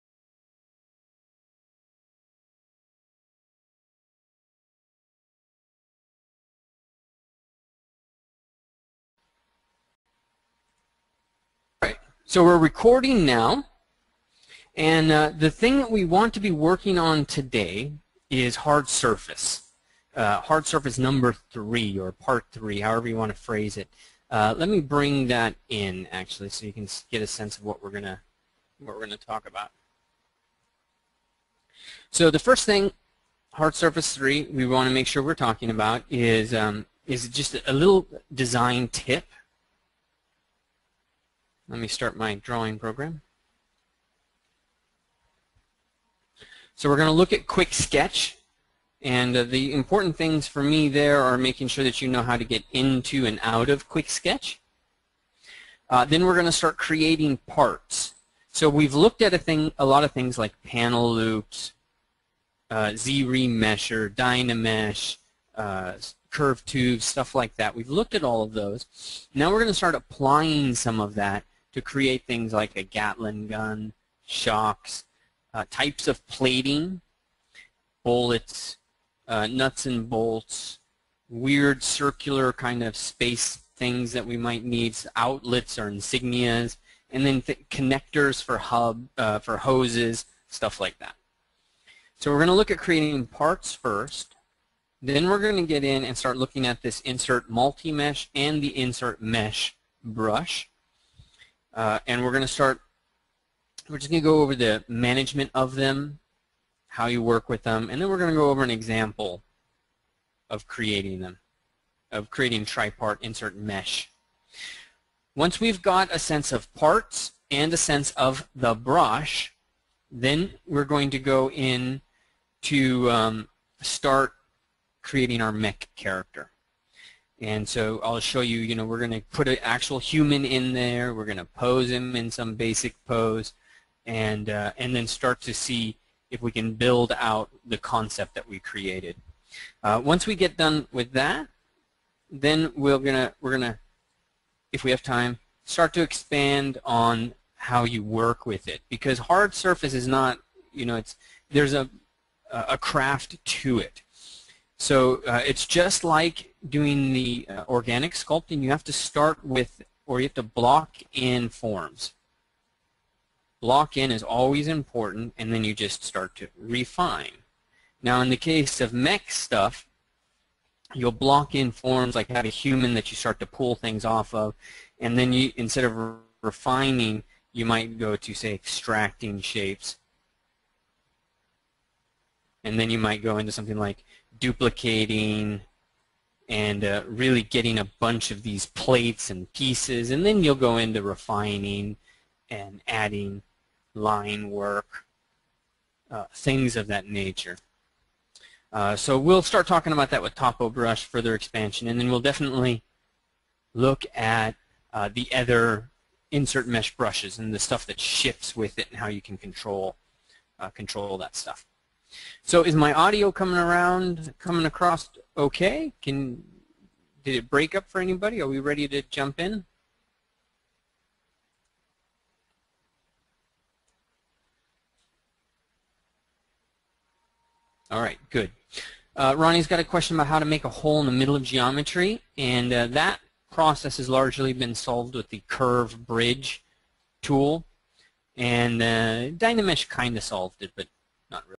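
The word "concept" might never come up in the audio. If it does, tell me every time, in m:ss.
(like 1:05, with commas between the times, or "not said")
2:17.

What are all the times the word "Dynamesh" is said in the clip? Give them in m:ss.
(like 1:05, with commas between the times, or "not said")
1:04, 3:59.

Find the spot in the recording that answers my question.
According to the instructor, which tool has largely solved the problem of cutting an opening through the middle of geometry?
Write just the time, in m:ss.
3:55.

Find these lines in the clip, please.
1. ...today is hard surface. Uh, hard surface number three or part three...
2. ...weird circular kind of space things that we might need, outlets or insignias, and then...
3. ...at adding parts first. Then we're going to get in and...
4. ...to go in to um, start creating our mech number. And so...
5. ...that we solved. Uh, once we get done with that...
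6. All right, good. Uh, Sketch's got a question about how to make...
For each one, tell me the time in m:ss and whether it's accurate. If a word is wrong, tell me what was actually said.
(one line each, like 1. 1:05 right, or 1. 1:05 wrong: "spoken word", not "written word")
1. 0:17 right
2. 1:21 right
3. 1:32 wrong: "creating", not "adding"
4. 2:01 wrong: "character", not "number"
5. 2:18 wrong: "created", not "solved"
6. 3:47 wrong: "Ronnie", not "Sketch".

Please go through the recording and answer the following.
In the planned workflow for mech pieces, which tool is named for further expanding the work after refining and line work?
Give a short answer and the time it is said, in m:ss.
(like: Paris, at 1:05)
Topo Brush, at 3:20.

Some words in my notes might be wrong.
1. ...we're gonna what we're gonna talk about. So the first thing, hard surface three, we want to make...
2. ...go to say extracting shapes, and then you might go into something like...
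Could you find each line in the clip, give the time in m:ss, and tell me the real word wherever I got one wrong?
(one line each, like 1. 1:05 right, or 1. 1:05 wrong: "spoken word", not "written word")
1. 0:27 right
2. 2:57 right.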